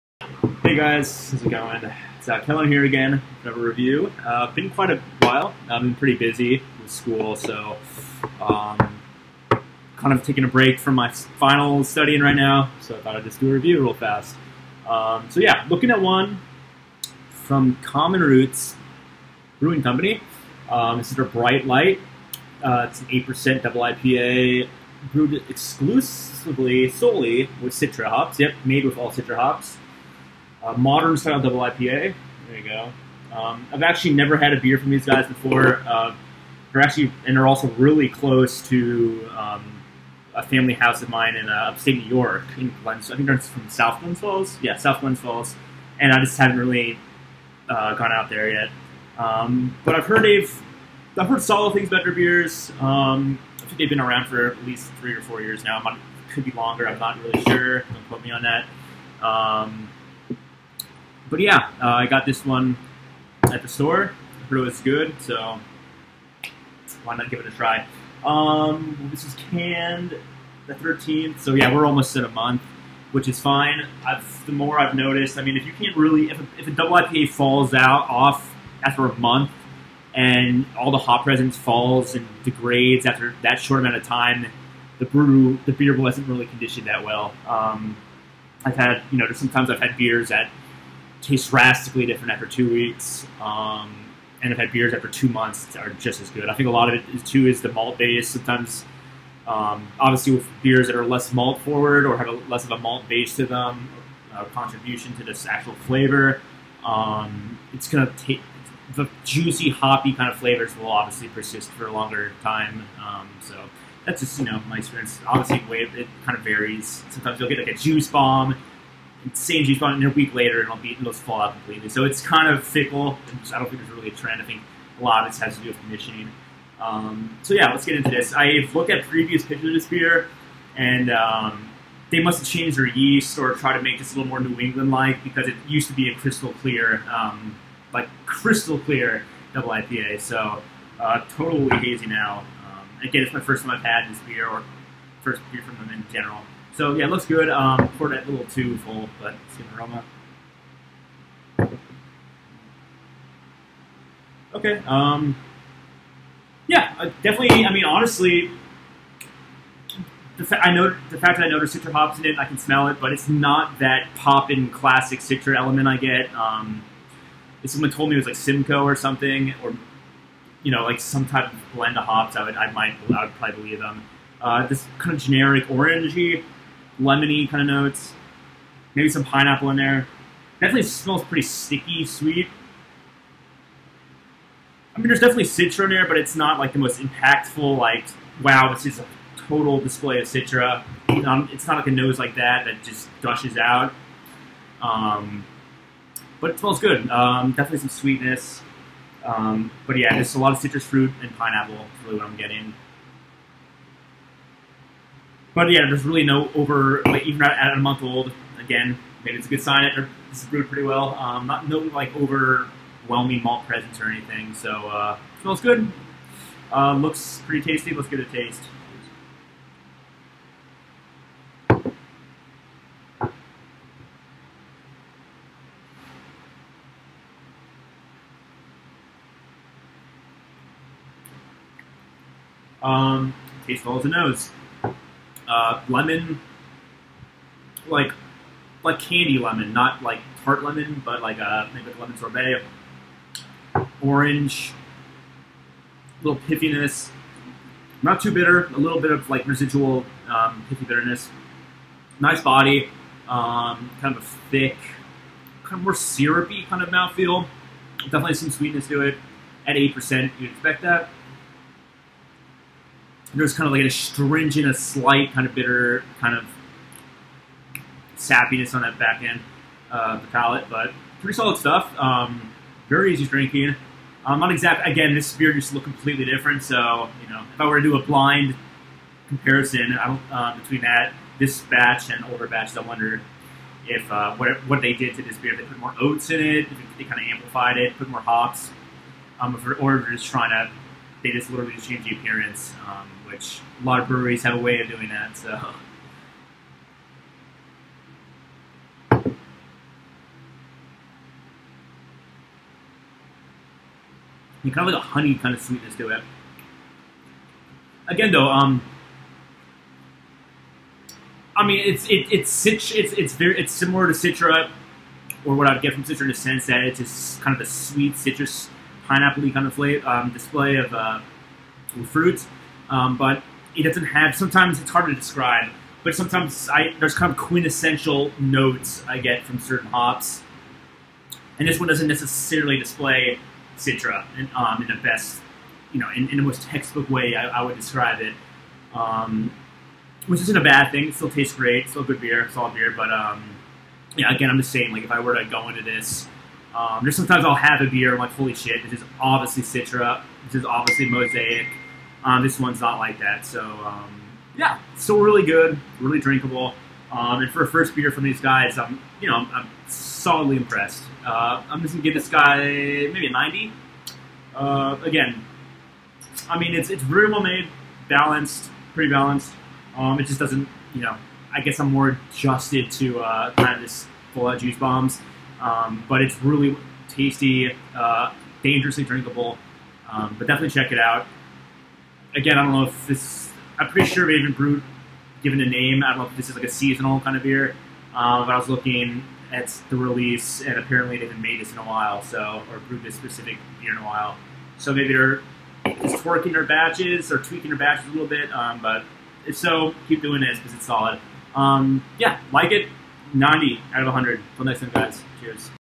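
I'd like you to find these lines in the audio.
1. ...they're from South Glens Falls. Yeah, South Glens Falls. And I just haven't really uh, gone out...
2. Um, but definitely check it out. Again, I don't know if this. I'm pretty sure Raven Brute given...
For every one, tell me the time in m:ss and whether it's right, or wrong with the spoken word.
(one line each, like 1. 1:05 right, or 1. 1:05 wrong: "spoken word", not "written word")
1. 0:43 right
2. 6:20 right.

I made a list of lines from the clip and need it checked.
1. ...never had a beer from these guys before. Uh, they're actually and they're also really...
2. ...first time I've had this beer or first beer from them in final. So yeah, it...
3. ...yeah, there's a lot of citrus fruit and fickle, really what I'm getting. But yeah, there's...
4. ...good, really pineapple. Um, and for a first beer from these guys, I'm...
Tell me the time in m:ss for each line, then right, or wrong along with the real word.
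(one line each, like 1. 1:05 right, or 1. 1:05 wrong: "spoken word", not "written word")
1. 0:34 right
2. 2:23 wrong: "general", not "final"
3. 3:19 wrong: "pineapple", not "fickle"
4. 5:55 wrong: "drinkable", not "pineapple".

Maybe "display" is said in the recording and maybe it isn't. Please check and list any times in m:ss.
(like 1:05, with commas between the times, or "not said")
3:09, 5:20, 5:32.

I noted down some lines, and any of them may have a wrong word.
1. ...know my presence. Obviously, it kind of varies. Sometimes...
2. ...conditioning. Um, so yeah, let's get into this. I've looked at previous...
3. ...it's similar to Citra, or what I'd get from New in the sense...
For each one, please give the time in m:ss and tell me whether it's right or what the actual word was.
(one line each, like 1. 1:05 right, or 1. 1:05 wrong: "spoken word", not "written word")
1. 1:54 wrong: "experience", not "presence"
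2. 2:05 right
3. 5:13 wrong: "Citra", not "New".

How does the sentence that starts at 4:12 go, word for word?
Nice body, um, kind of a thick, kind of more syrupy kind of mouthfeel.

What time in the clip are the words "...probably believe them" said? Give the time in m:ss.
2:53.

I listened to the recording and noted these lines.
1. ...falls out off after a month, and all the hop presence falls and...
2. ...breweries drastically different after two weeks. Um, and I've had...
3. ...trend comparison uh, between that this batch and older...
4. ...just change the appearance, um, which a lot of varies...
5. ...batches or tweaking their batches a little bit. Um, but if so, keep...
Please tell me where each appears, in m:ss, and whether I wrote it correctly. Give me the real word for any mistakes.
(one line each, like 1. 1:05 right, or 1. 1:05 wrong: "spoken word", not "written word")
1. 1:17 right
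2. 1:31 wrong: "tastes", not "breweries"
3. 4:38 wrong: "blind", not "trend"
4. 4:51 wrong: "breweries", not "varies"
5. 6:36 right.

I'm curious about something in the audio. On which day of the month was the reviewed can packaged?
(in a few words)
13th.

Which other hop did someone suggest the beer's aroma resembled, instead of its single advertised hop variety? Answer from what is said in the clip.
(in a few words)
Simcoe.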